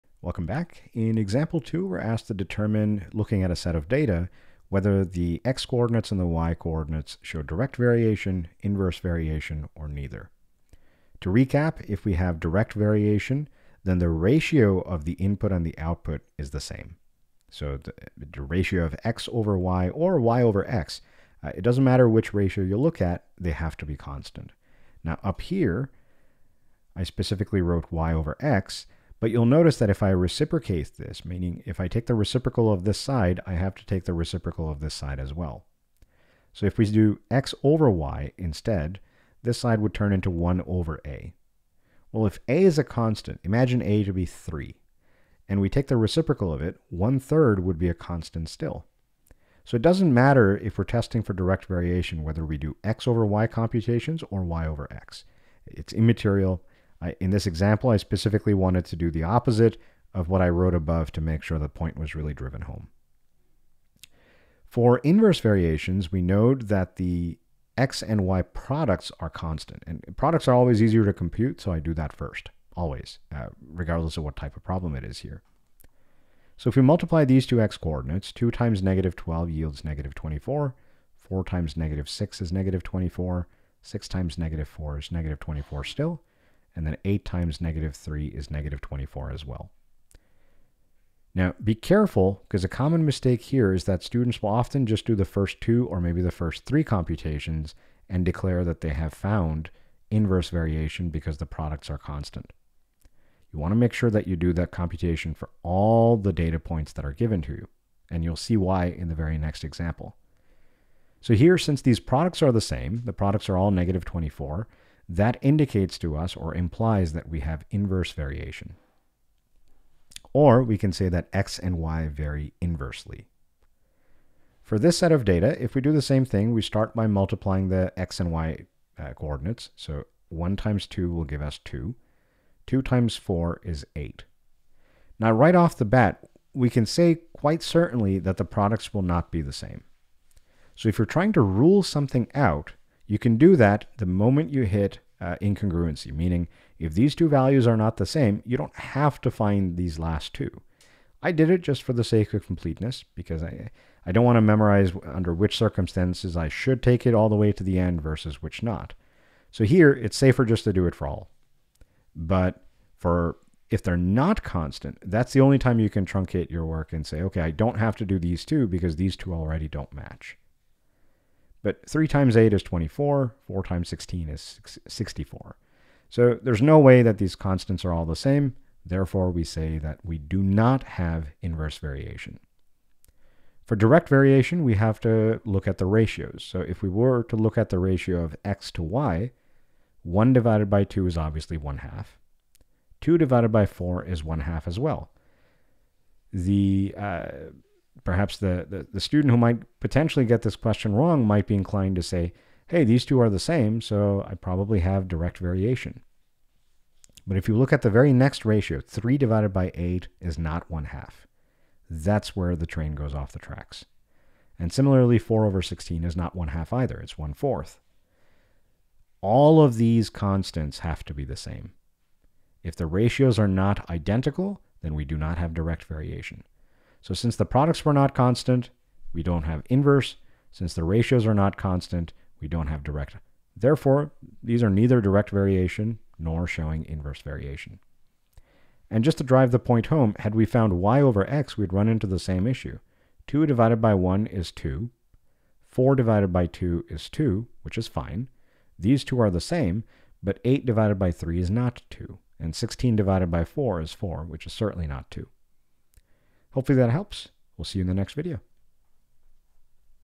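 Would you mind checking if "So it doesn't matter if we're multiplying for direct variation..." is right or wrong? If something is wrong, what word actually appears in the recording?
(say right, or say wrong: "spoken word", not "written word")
wrong: "testing", not "multiplying".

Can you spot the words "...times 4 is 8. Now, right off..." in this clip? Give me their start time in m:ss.
2:12.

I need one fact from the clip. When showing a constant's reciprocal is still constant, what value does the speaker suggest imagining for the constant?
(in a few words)
3.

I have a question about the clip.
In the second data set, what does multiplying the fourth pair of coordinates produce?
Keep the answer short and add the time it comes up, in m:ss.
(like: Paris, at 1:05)
64, at 2:54.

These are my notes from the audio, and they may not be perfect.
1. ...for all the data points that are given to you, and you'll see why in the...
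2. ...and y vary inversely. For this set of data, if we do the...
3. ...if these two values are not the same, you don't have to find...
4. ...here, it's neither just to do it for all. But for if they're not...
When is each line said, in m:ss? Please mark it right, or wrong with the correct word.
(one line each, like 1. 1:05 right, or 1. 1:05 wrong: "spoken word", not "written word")
1. 1:45 right
2. 2:01 right
3. 2:26 right
4. 2:39 wrong: "safer", not "neither".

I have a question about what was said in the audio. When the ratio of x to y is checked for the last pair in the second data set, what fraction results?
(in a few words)
1/4.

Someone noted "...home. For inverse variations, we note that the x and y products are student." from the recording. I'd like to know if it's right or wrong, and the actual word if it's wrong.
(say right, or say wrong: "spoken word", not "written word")
wrong: "constant", not "student".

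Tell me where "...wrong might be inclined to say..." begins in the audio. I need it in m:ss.
3:20.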